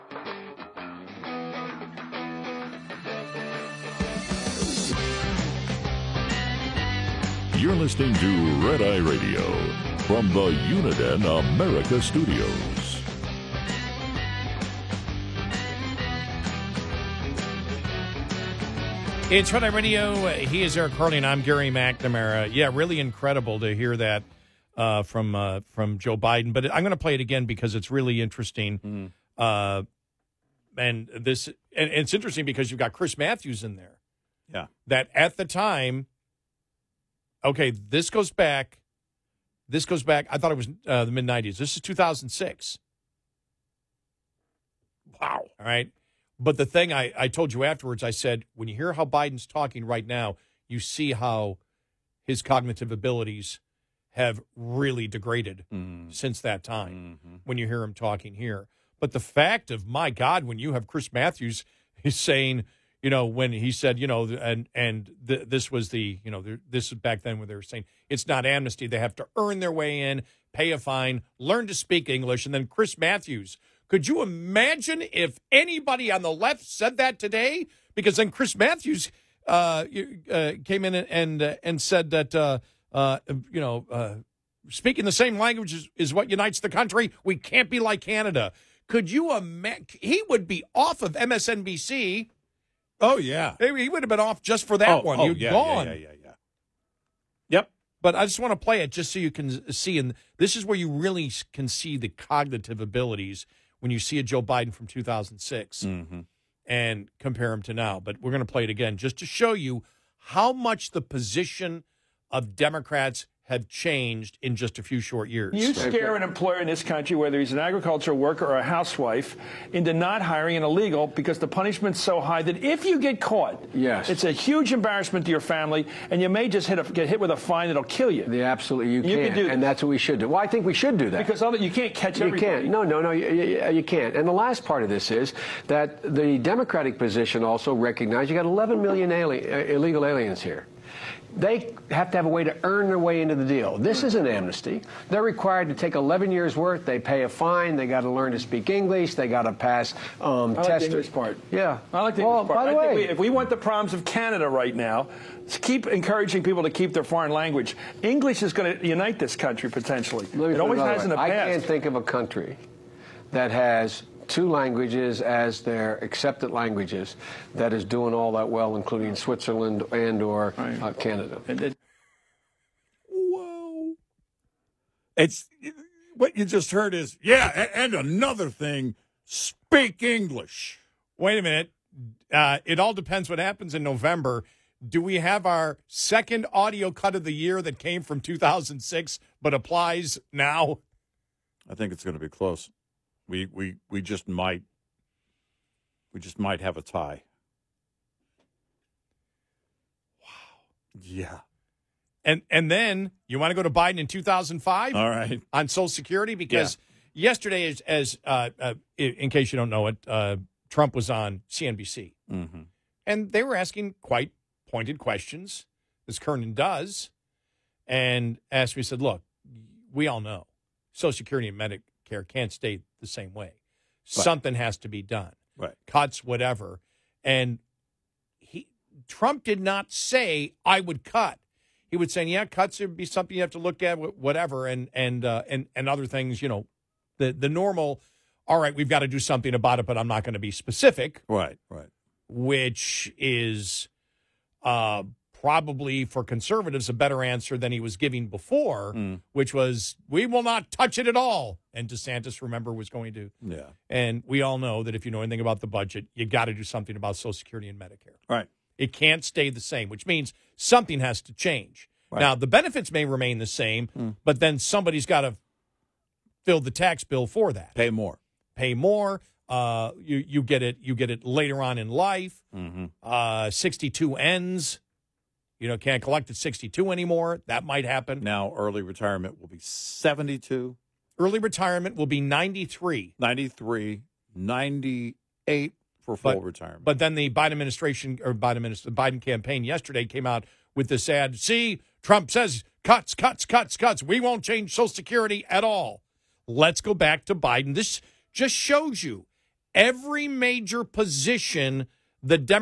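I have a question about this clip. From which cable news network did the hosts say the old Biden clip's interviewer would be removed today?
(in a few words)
MSNBC.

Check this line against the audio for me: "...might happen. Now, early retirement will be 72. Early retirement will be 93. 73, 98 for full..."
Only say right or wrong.
wrong.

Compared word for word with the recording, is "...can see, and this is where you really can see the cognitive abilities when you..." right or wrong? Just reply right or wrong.
right.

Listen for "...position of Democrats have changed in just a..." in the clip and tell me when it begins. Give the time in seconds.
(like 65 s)
111 s.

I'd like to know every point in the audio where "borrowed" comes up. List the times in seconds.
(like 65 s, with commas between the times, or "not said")
not said.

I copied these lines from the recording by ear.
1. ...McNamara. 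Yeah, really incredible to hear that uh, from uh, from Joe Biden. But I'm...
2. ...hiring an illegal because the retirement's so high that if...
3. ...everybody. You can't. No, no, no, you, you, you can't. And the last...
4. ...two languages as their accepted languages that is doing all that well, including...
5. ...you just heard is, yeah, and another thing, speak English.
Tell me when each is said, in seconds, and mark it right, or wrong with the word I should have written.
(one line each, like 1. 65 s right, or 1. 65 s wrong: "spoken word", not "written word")
1. 21 s right
2. 120 s wrong: "punishment", not "retirement"
3. 132 s right
4. 164 s right
5. 176 s right.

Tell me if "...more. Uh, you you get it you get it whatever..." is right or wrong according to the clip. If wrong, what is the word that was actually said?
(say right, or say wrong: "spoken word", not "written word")
wrong: "later", not "whatever".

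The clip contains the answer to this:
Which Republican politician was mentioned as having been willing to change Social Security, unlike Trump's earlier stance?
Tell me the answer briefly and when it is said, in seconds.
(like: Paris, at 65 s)
DeSantis, at 251 s.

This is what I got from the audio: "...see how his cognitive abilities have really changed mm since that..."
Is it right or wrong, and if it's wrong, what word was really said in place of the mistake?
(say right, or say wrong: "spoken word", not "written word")
wrong: "degraded", not "changed".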